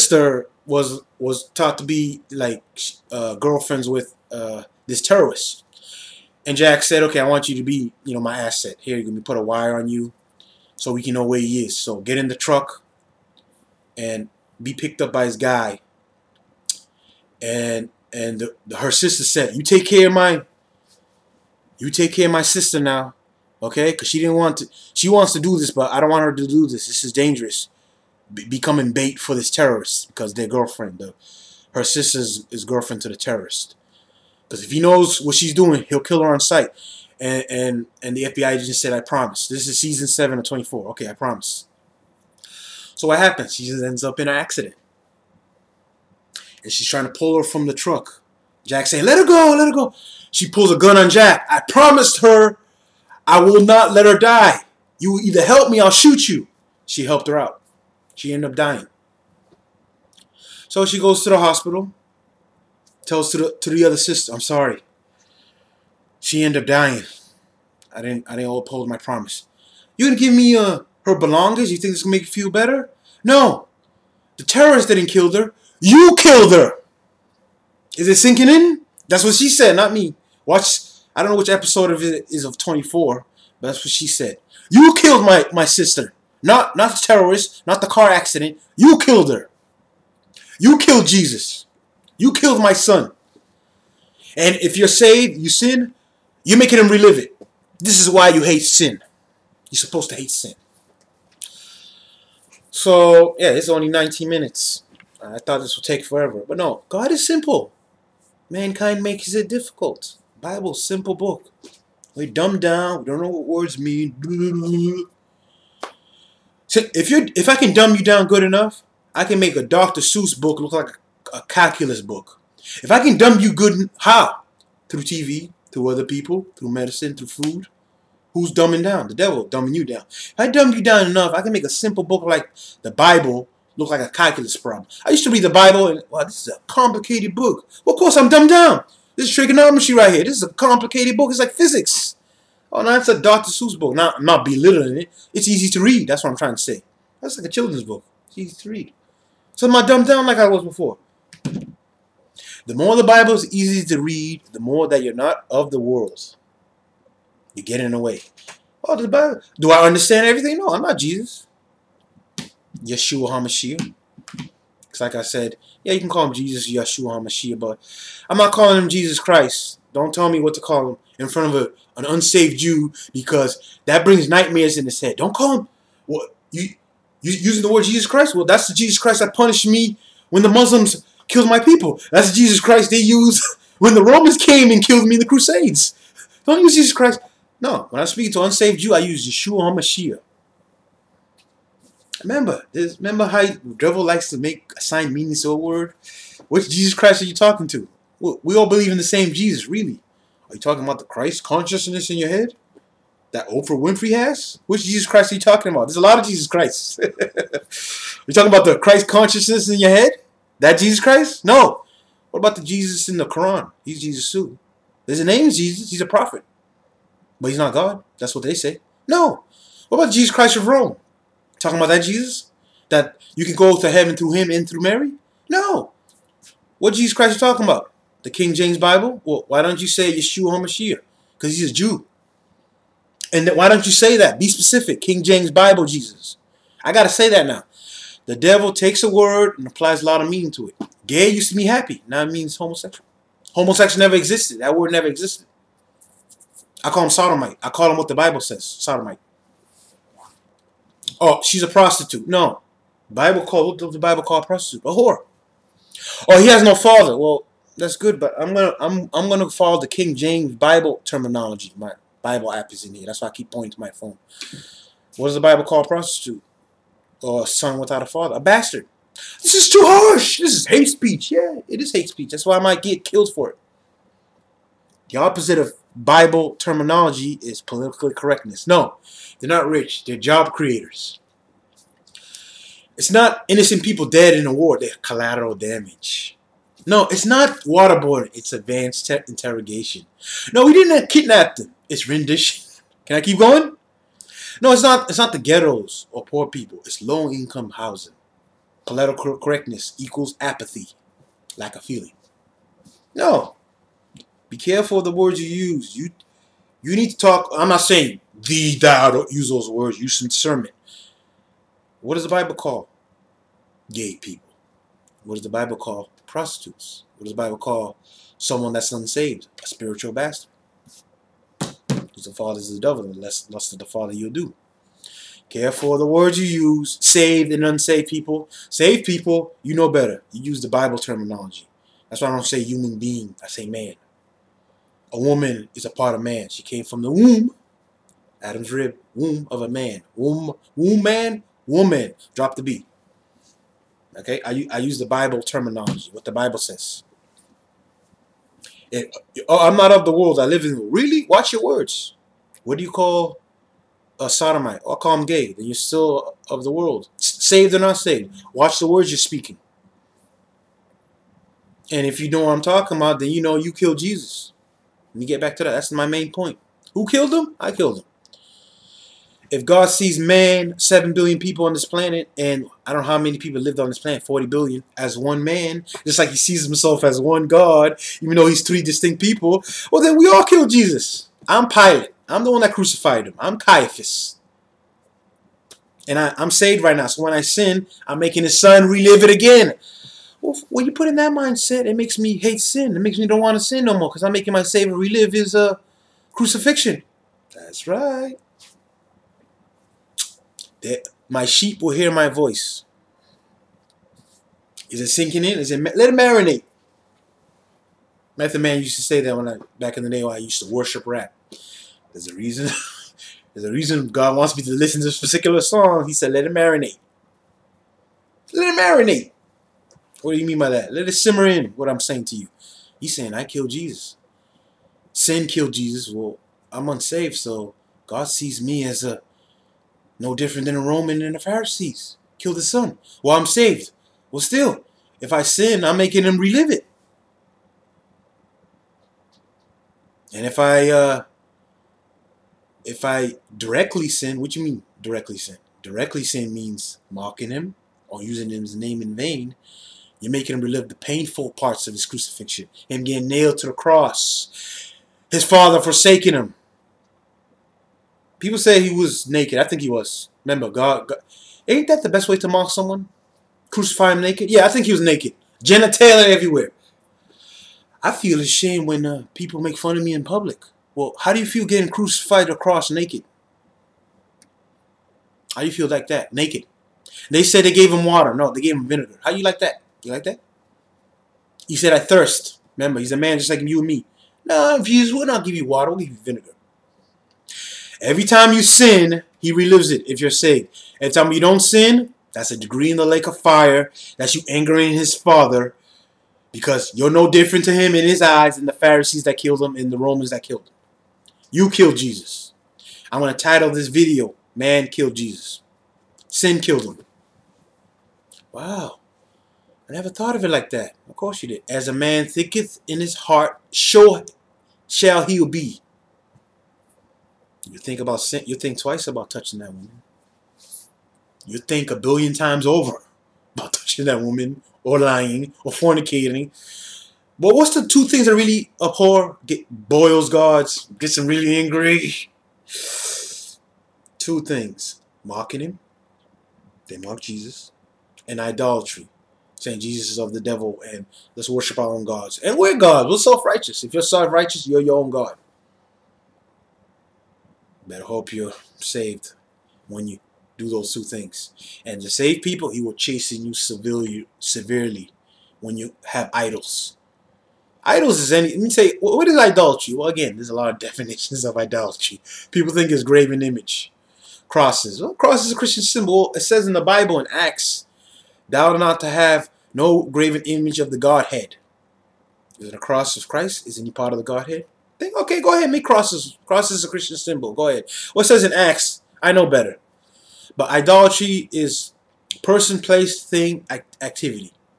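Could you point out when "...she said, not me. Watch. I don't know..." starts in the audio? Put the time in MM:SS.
01:19.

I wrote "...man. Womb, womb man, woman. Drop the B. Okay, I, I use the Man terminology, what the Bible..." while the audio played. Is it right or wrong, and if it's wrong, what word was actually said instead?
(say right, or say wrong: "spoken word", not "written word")
wrong: "Bible", not "Man".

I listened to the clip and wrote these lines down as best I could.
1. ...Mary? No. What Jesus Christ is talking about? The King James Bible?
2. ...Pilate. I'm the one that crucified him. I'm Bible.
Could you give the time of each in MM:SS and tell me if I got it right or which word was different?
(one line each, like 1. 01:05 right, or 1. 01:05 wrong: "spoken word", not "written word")
1. 03:44 right
2. 06:21 wrong: "Caiaphas", not "Bible".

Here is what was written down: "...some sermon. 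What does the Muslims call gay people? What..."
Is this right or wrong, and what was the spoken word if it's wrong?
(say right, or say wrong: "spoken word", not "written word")
wrong: "Bible", not "Muslims".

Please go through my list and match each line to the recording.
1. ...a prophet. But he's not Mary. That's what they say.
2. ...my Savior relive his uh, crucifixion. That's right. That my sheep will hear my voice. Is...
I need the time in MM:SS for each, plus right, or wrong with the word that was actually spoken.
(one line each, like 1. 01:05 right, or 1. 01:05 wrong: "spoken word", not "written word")
1. 03:36 wrong: "God", not "Mary"
2. 06:34 right.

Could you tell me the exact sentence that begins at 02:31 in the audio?
The more the Bible is easy to read, the more that you're not of the world.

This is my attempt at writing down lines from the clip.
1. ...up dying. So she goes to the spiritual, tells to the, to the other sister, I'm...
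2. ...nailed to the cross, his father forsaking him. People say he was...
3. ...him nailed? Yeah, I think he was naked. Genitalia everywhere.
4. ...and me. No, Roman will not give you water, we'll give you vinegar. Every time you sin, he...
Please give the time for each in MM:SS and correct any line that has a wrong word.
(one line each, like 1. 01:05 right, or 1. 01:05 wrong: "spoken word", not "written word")
1. 00:58 wrong: "hospital", not "spiritual"
2. 07:33 right
3. 07:44 wrong: "naked", not "nailed"
4. 08:03 wrong: "Jesus", not "Roman".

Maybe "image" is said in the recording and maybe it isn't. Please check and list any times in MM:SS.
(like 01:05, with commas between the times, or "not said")
09:23, 09:30.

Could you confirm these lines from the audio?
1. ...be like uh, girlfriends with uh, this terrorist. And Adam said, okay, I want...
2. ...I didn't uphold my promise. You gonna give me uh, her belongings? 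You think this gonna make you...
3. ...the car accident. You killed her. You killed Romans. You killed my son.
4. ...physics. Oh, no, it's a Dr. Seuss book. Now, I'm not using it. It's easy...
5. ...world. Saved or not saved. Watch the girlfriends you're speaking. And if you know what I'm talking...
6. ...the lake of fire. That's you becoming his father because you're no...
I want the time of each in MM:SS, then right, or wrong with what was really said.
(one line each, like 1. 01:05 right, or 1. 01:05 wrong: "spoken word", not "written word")
1. 00:01 wrong: "Jack", not "Adam"
2. 01:08 right
3. 01:27 wrong: "Jesus", not "Romans"
4. 02:21 wrong: "belittling", not "using"
5. 05:56 wrong: "words", not "girlfriends"
6. 08:12 wrong: "angering", not "becoming".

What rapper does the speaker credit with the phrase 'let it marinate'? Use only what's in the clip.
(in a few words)
Method Man.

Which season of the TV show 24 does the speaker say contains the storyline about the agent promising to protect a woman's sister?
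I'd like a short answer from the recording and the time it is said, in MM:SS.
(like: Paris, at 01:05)
Season 7, at 00:39.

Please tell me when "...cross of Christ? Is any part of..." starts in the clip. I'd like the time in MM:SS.
09:32.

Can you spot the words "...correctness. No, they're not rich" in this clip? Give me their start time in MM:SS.
04:38.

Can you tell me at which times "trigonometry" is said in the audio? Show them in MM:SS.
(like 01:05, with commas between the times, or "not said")
02:19.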